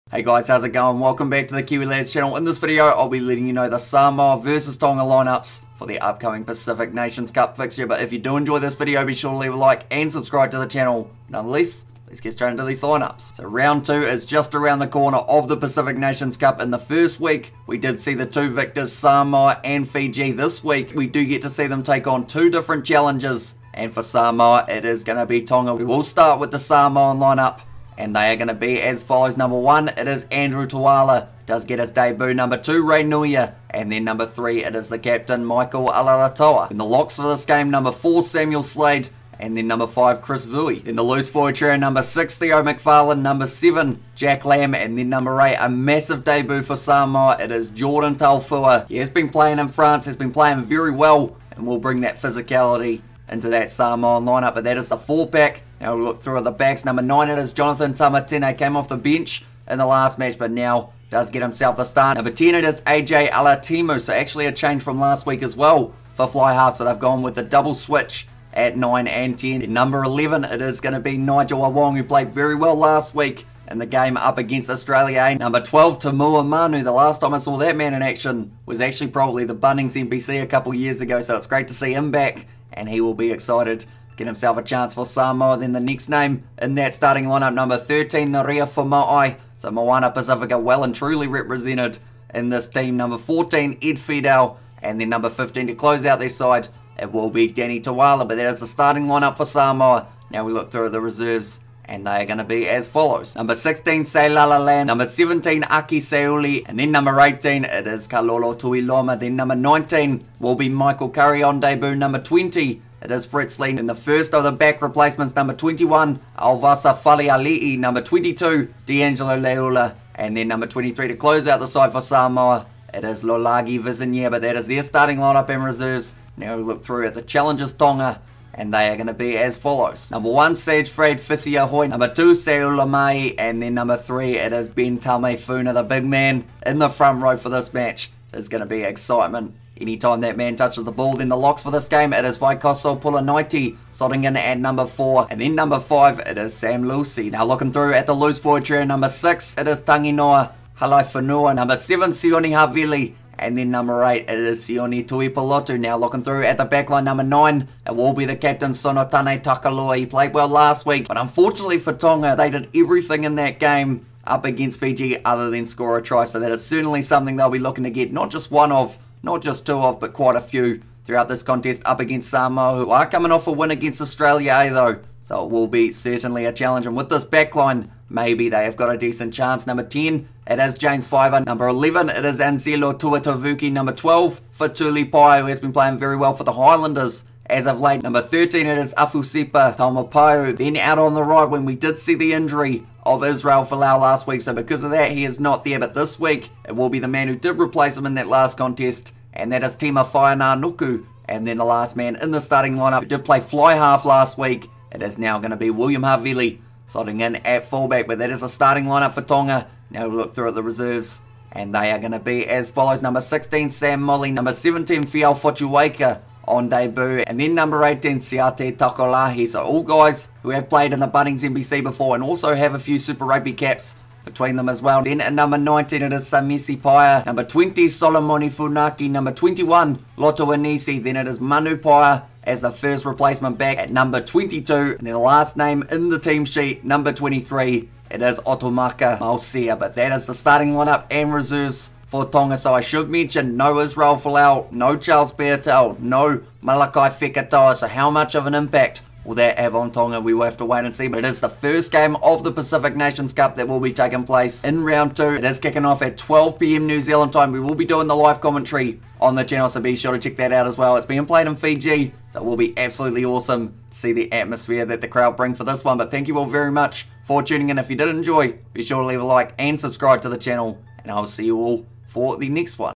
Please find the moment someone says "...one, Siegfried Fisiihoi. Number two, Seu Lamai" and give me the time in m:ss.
2:10.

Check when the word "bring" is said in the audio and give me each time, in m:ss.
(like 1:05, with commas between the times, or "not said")
0:51, 4:25.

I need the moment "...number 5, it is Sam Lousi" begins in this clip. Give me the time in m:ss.
2:25.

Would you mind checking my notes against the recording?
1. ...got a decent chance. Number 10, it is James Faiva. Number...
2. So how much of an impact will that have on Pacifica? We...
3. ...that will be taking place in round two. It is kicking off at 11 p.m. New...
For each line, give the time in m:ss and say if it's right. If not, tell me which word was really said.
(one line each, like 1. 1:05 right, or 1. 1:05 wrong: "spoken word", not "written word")
1. 2:58 right
2. 4:07 wrong: "Tonga", not "Pacifica"
3. 4:13 wrong: "12", not "11".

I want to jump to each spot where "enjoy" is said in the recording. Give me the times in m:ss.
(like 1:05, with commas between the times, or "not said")
0:08, 4:28.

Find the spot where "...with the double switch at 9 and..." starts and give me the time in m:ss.
1:07.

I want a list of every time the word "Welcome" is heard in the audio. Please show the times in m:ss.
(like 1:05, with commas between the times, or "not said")
0:00.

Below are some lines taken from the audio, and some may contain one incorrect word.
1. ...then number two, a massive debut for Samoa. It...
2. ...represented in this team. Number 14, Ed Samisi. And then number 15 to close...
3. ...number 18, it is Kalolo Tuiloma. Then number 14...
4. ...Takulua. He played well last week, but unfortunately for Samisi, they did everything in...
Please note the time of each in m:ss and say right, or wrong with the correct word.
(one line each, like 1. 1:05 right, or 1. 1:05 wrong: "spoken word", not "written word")
1. 0:44 wrong: "eight", not "two"
2. 1:31 wrong: "Fidow", not "Samisi"
3. 1:46 wrong: "19", not "14"
4. 2:39 wrong: "Tonga", not "Samisi".